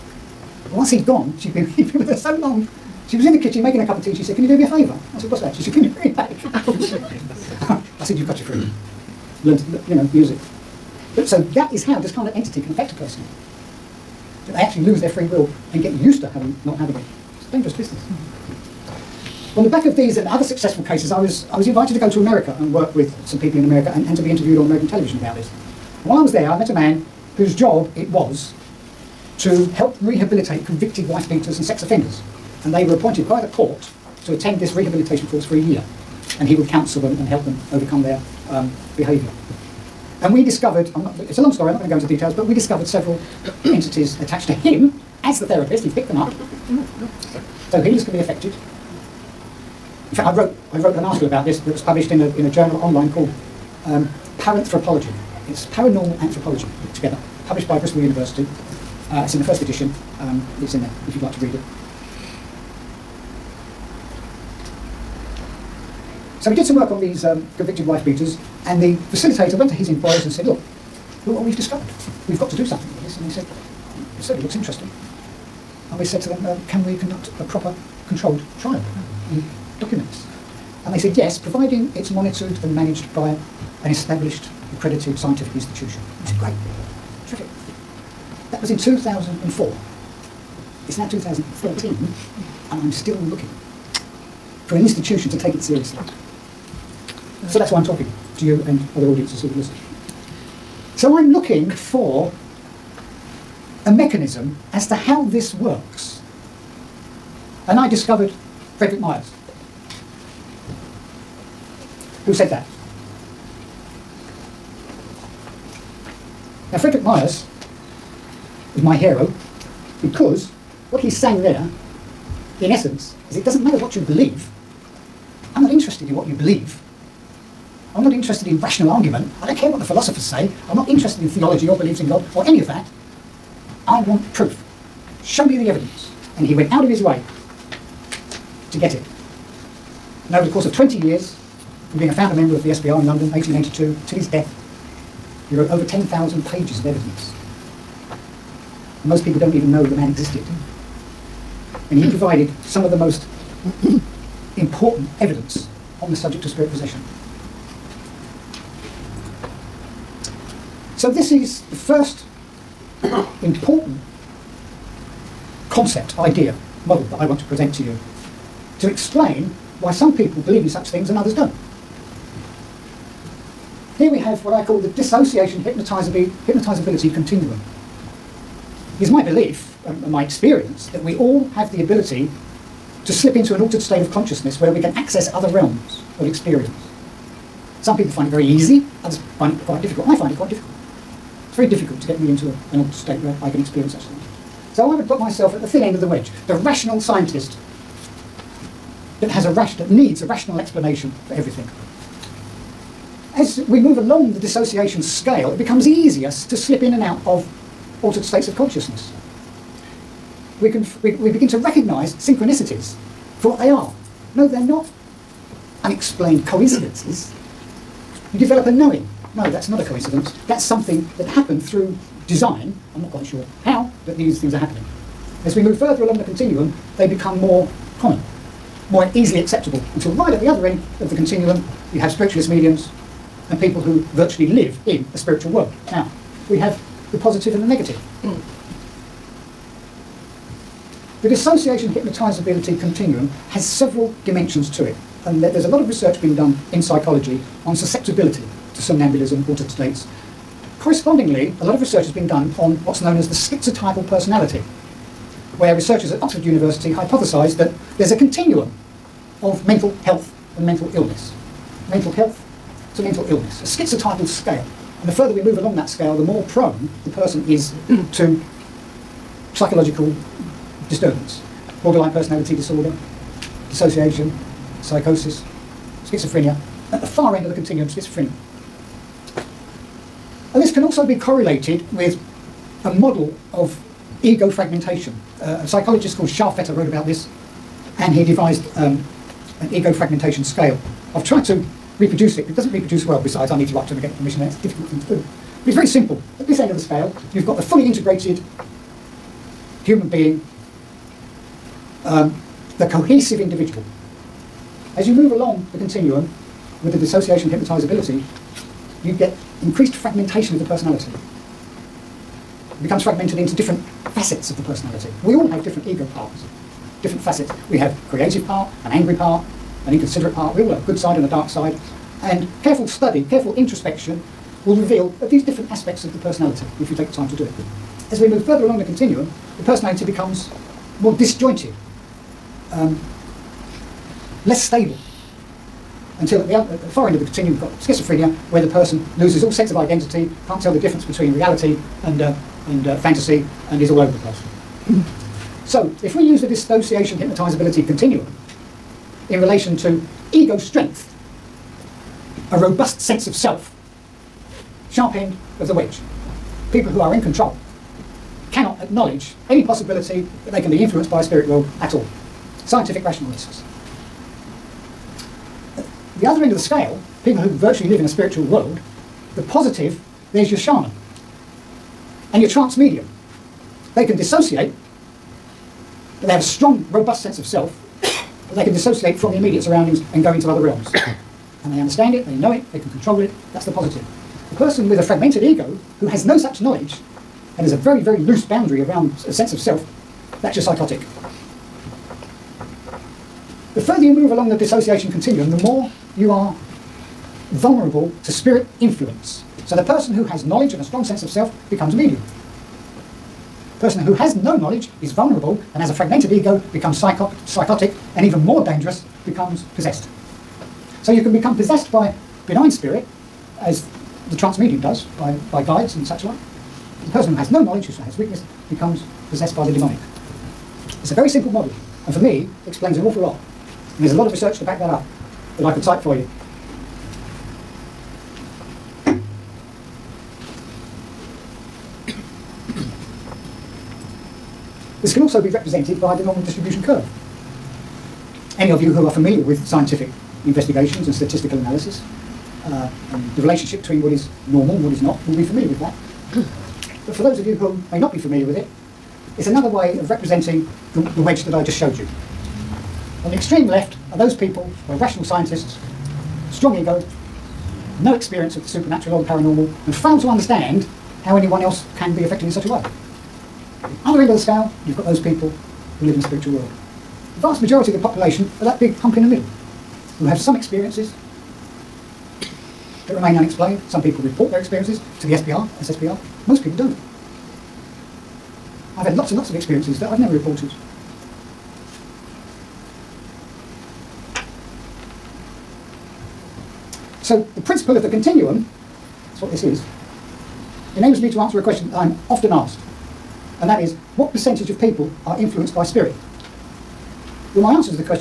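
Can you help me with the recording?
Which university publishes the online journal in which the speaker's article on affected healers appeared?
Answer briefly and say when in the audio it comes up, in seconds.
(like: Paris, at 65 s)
Bristol University, at 57 s.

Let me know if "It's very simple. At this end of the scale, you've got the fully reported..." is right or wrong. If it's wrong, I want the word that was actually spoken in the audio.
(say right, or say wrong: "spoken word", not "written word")
wrong: "integrated", not "reported".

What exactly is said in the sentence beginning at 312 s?
It becomes fragmented into different facets of the personality.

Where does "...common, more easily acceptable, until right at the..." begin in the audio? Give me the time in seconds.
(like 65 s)
227 s.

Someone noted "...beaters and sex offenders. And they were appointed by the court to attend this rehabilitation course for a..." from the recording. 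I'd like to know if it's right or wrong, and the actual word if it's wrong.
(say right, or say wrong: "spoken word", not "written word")
right.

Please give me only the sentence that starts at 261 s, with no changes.
Mental health to mental illness, a schizotypal scale.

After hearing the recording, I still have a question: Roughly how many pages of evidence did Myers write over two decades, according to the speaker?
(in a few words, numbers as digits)
10,000.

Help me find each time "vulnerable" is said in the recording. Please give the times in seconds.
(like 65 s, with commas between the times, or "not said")
397 s, 405 s.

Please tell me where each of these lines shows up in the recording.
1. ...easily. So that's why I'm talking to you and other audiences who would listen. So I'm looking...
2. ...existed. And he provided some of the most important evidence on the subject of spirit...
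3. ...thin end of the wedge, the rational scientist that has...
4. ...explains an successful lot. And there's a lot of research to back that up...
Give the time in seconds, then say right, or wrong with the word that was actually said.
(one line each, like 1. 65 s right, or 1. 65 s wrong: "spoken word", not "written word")
1. 95 s wrong: "seriously", not "easily"
2. 150 s right
3. 195 s right
4. 422 s wrong: "awful", not "successful".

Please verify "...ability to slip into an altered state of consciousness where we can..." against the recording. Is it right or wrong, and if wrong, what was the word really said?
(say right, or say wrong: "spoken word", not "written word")
right.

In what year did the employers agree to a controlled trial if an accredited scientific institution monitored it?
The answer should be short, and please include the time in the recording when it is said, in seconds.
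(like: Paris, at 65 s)
2004, at 88 s.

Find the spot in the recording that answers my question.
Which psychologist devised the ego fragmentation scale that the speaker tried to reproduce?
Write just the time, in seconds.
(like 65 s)
286 s.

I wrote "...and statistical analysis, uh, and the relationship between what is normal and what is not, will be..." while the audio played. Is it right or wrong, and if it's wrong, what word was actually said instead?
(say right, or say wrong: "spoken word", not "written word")
right.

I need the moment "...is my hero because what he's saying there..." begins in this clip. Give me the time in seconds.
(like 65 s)
118 s.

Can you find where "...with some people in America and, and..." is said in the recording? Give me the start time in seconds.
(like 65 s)
22 s.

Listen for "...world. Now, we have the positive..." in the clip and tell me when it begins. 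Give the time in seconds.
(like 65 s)
235 s.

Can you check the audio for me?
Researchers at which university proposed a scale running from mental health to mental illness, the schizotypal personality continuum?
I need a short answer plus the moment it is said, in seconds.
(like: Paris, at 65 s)
Oxford University, at 256 s.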